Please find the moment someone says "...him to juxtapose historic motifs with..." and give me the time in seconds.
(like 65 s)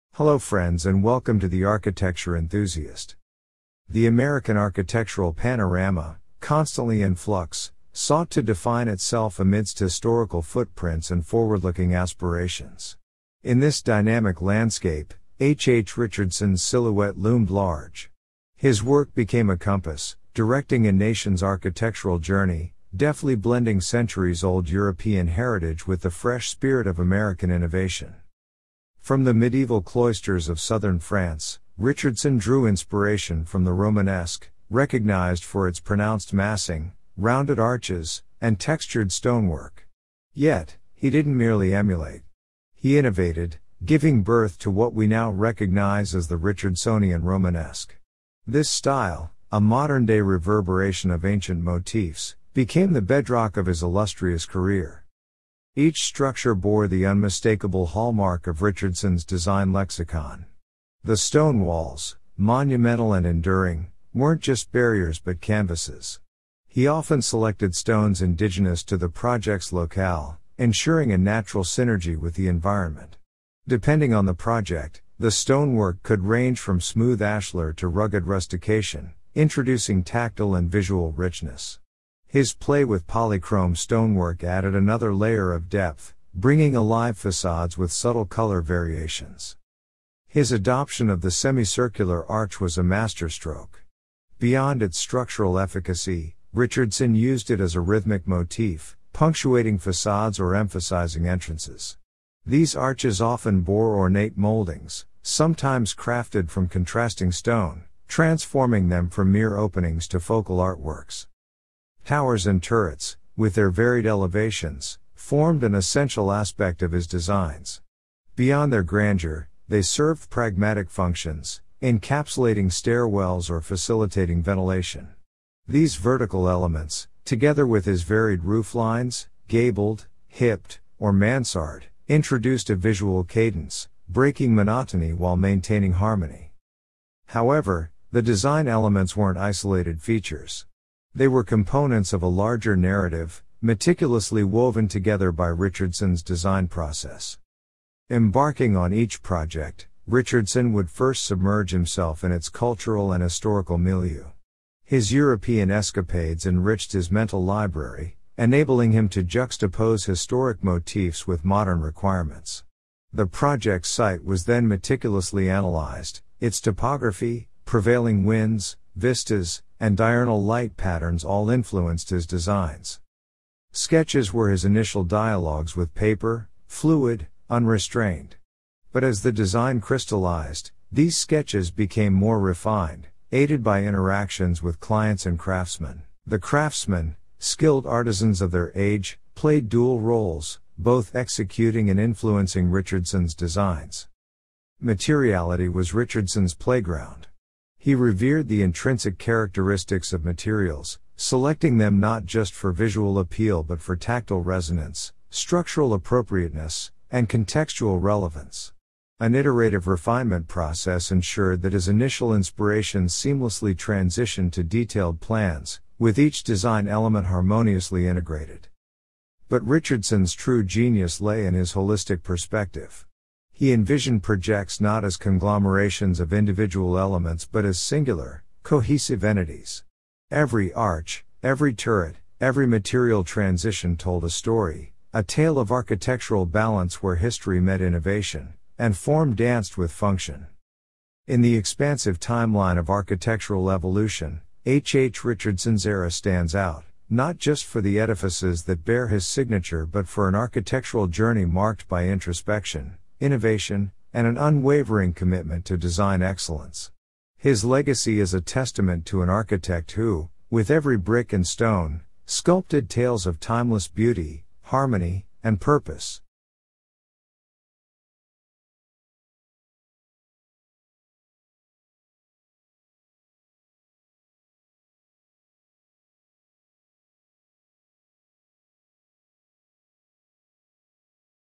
158 s.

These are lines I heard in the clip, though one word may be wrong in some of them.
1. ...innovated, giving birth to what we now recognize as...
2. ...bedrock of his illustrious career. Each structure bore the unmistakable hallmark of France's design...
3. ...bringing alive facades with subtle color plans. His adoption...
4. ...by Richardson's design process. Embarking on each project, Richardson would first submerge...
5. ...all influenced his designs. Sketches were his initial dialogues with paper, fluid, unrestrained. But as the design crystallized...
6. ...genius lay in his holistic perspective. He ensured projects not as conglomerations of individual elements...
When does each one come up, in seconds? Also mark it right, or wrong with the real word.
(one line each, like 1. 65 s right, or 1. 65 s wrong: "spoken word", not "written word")
1. 42 s right
2. 53 s wrong: "Richardson", not "France"
3. 86 s wrong: "variations", not "plans"
4. 145 s right
5. 171 s right
6. 220 s wrong: "envisioned", not "ensured".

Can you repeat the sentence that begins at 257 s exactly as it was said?
His legacy is a testament to an architect who, with every brick and stone, sculpted tales of timeless beauty, harmony, and purpose.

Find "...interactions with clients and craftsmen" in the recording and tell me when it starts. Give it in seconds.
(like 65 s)
183 s.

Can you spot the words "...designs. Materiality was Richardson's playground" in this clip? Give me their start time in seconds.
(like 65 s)
193 s.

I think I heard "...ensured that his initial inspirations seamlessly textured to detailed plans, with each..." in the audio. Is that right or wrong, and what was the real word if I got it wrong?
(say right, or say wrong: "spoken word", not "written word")
wrong: "transitioned", not "textured".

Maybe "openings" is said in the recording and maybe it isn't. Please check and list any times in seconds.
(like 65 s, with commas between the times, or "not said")
109 s.